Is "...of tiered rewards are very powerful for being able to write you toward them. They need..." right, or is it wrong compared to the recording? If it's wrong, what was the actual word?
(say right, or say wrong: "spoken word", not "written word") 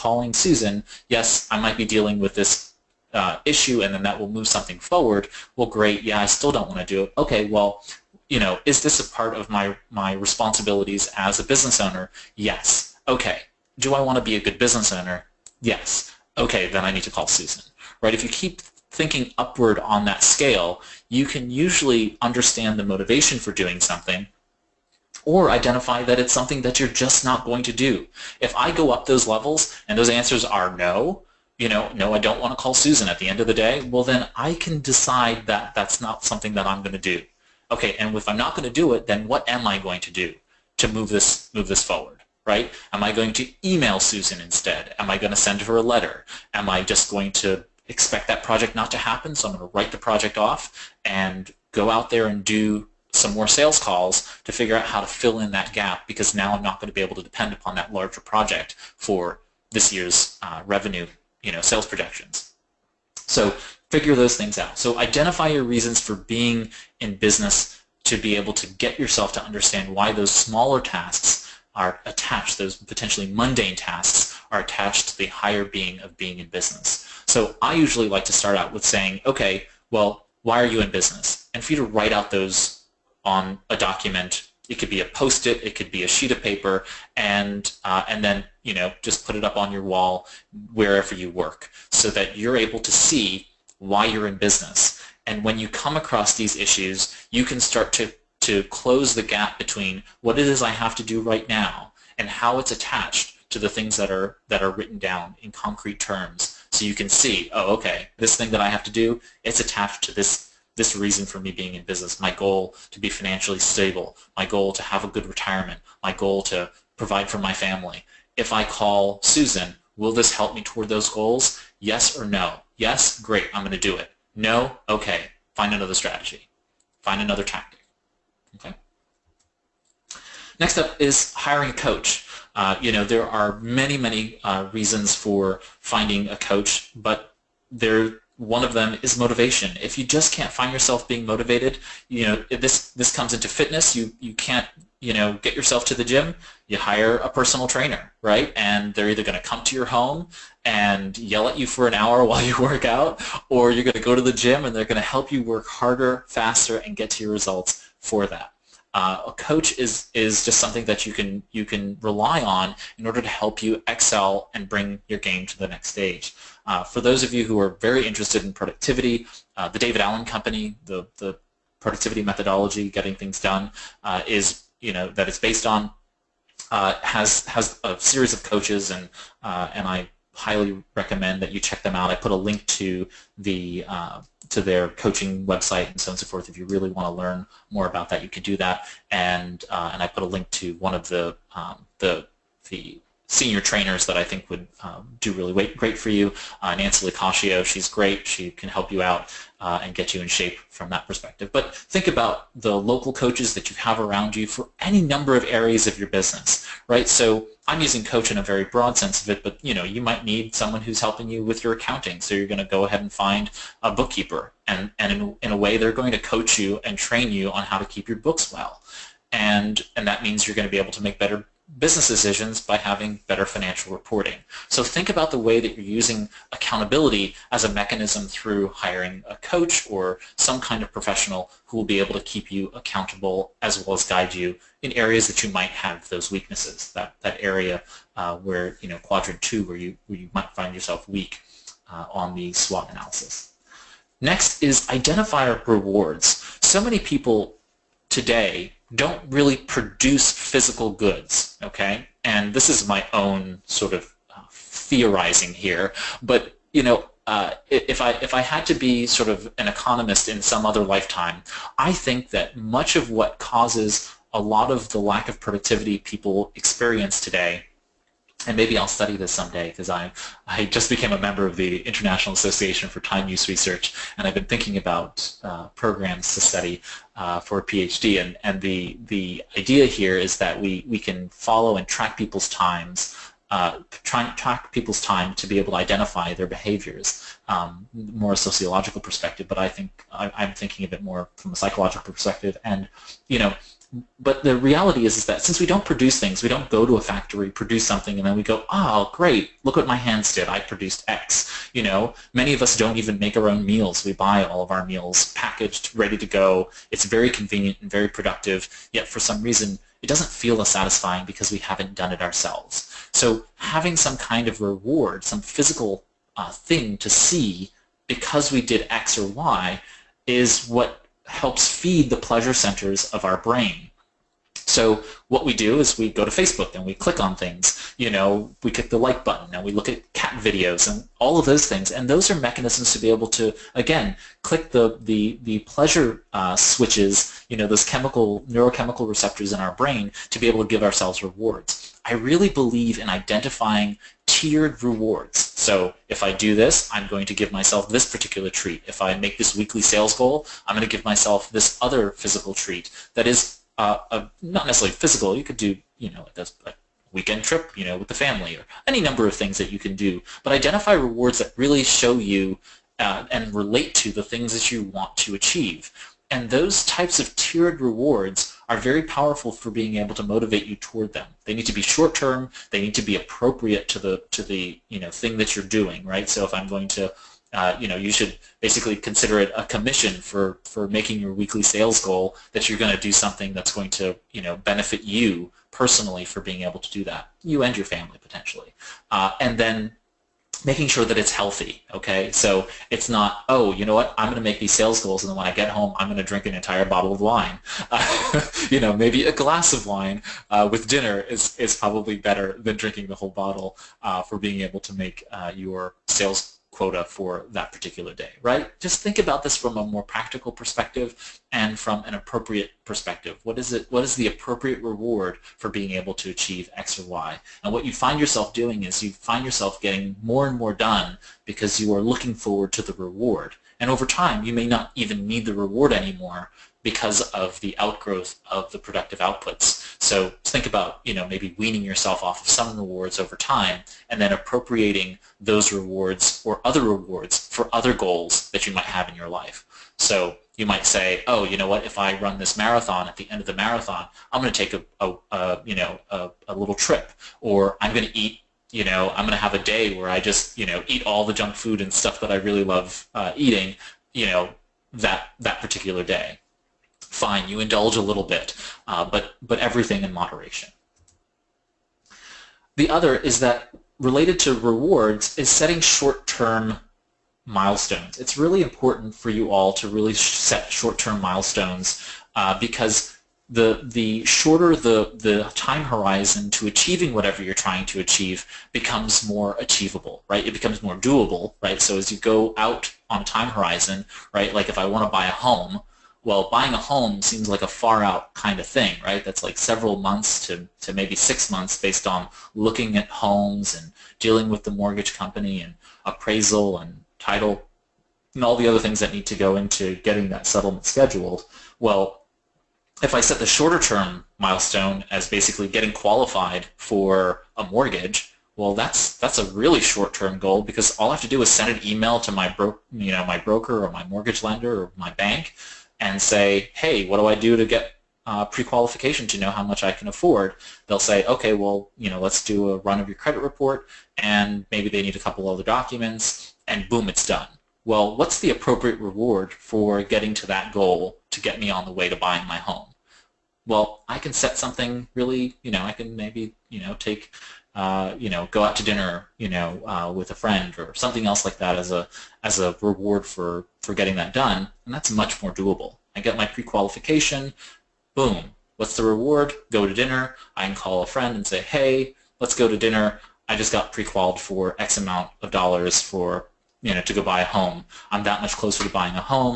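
wrong: "motivate", not "write".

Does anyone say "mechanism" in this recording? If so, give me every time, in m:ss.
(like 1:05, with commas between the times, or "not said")
3:47, 5:32.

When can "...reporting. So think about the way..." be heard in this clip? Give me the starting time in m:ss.
3:43.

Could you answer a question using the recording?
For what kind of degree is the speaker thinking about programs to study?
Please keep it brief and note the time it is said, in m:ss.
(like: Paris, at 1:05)
PhD, at 4:37.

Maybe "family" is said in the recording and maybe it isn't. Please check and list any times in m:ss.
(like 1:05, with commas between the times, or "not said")
1:57, 5:58, 6:27.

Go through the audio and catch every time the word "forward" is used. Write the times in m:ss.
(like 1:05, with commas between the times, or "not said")
0:04, 0:41, 7:02.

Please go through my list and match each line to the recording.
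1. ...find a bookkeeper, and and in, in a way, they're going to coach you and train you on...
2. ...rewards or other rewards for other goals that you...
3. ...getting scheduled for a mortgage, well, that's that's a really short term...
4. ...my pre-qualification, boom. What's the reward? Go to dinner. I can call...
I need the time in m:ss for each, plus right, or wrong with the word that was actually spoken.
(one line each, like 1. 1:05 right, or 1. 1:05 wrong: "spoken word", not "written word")
1. 3:33 right
2. 7:15 right
3. 8:25 wrong: "qualified", not "scheduled"
4. 9:06 right.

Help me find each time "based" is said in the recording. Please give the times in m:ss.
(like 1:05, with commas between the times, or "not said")
2:55, 8:11.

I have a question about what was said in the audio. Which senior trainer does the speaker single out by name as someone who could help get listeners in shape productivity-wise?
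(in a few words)
Nancy Licascio.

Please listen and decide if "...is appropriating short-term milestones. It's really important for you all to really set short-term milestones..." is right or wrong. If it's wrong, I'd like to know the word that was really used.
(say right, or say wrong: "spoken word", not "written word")
wrong: "setting", not "appropriating".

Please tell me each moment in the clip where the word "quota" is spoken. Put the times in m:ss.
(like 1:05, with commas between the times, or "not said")
6:46.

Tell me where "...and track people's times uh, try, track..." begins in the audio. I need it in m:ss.
4:41.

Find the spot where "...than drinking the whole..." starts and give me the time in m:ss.
6:42.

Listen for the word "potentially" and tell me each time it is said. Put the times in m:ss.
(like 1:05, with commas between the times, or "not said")
1:12, 6:28.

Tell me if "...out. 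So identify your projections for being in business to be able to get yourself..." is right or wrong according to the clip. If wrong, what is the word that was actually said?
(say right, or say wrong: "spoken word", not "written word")
wrong: "reasons", not "projections".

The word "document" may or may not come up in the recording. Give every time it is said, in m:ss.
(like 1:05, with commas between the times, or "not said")
1:23, 8:45.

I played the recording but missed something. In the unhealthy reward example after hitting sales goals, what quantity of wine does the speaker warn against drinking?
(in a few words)
An entire bottle.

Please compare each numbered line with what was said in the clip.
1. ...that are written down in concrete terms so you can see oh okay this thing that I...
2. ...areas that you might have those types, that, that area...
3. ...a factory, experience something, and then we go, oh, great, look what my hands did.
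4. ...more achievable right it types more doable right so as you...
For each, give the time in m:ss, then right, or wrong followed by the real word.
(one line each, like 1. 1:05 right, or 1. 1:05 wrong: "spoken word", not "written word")
1. 1:44 right
2. 3:54 wrong: "weaknesses", not "types"
3. 4:56 wrong: "produce", not "experience"
4. 7:59 wrong: "becomes", not "types".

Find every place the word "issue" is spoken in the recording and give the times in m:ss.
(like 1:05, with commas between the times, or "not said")
0:03, 1:36.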